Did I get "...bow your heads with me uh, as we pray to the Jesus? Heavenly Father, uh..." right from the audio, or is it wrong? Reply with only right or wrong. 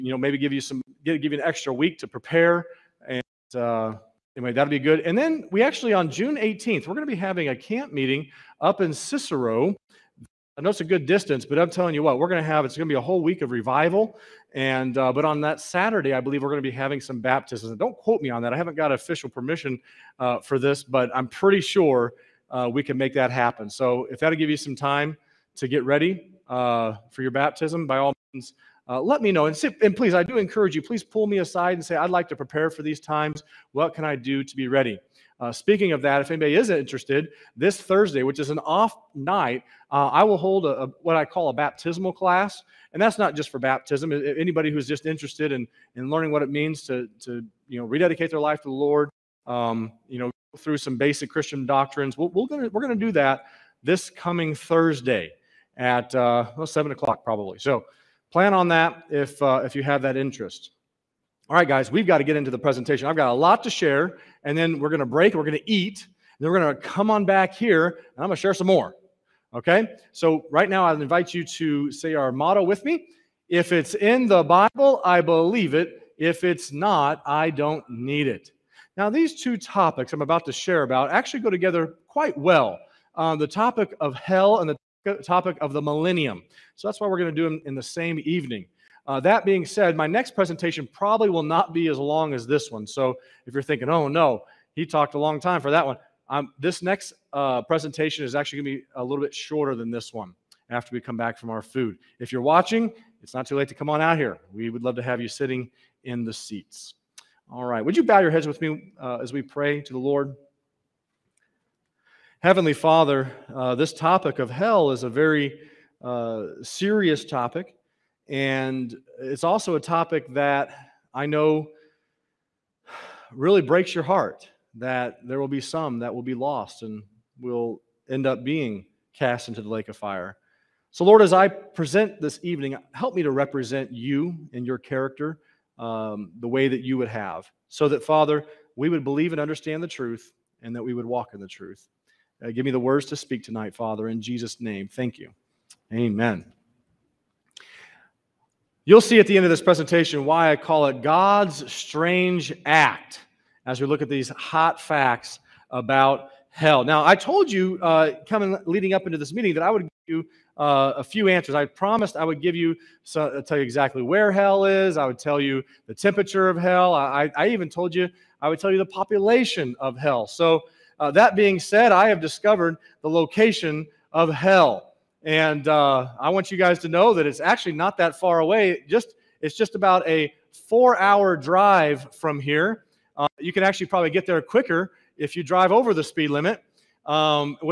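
wrong.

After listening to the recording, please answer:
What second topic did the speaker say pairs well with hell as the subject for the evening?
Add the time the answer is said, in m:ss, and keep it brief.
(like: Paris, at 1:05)
the millennium, at 1:25.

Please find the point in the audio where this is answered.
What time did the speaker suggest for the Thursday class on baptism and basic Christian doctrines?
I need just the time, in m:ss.
0:56.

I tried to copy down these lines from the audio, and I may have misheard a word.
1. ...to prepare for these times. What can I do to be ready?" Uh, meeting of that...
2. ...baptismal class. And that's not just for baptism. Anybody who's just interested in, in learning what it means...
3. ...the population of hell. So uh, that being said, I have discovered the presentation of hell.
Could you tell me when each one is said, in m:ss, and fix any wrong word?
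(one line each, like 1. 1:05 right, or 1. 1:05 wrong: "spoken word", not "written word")
1. 0:32 wrong: "speaking", not "meeting"
2. 0:41 right
3. 2:48 wrong: "location", not "presentation".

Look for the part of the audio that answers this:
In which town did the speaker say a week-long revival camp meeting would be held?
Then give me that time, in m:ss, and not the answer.
0:08.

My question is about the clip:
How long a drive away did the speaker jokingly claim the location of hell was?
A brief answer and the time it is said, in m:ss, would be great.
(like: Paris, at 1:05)
4 hours, at 3:00.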